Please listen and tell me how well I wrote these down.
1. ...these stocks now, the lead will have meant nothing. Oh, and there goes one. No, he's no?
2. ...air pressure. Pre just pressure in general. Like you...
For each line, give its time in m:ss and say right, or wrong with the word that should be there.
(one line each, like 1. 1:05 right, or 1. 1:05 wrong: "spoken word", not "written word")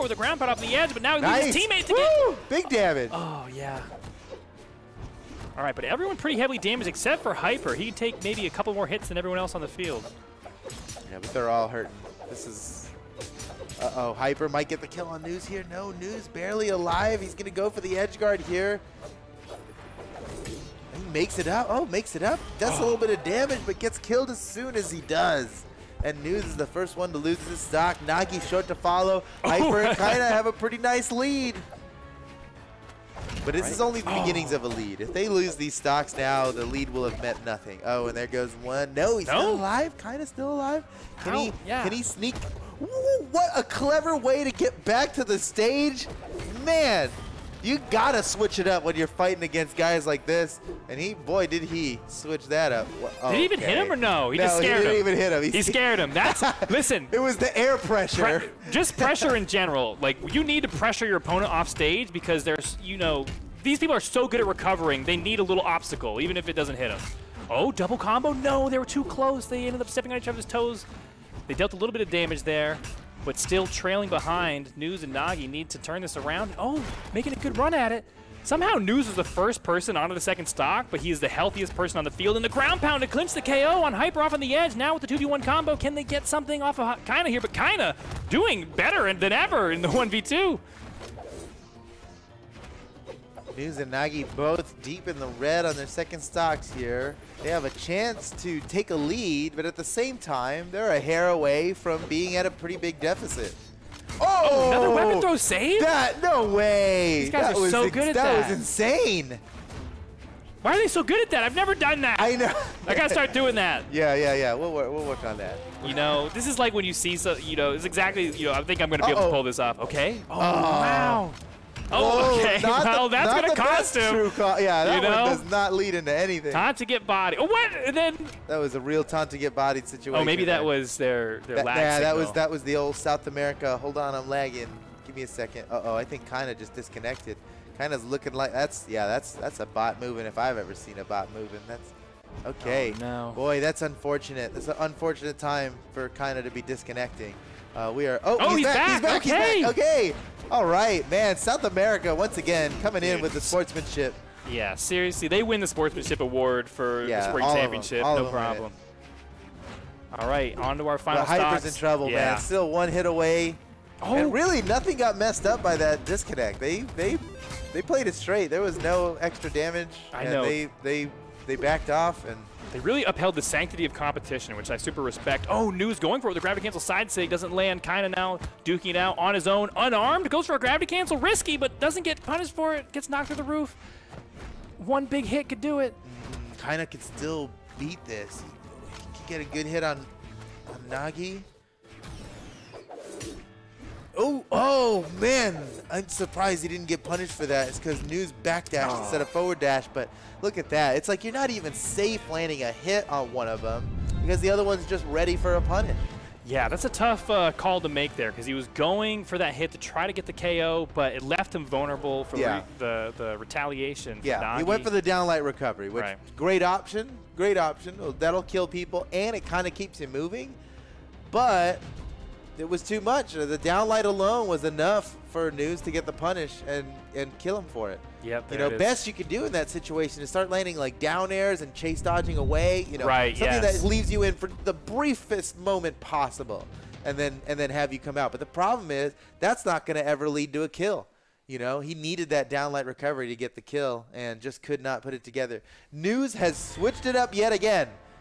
1. 0:35 right
2. 0:57 right.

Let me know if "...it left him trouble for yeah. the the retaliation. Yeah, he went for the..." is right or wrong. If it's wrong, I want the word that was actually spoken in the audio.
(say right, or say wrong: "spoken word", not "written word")
wrong: "vulnerable", not "trouble".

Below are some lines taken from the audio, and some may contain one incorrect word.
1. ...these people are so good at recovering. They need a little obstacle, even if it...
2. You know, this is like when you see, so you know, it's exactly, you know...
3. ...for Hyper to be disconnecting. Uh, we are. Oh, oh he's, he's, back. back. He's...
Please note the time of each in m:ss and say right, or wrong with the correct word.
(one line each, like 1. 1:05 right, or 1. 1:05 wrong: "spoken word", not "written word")
1. 1:03 right
2. 1:55 right
3. 2:25 wrong: "Kyna", not "Hyper".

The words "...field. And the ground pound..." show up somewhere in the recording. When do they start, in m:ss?
1:22.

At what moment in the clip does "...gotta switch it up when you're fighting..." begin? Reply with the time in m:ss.
0:47.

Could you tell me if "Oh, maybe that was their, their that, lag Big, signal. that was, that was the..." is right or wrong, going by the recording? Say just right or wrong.
wrong.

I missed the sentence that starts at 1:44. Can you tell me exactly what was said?
Oh, oh another weapon throw save?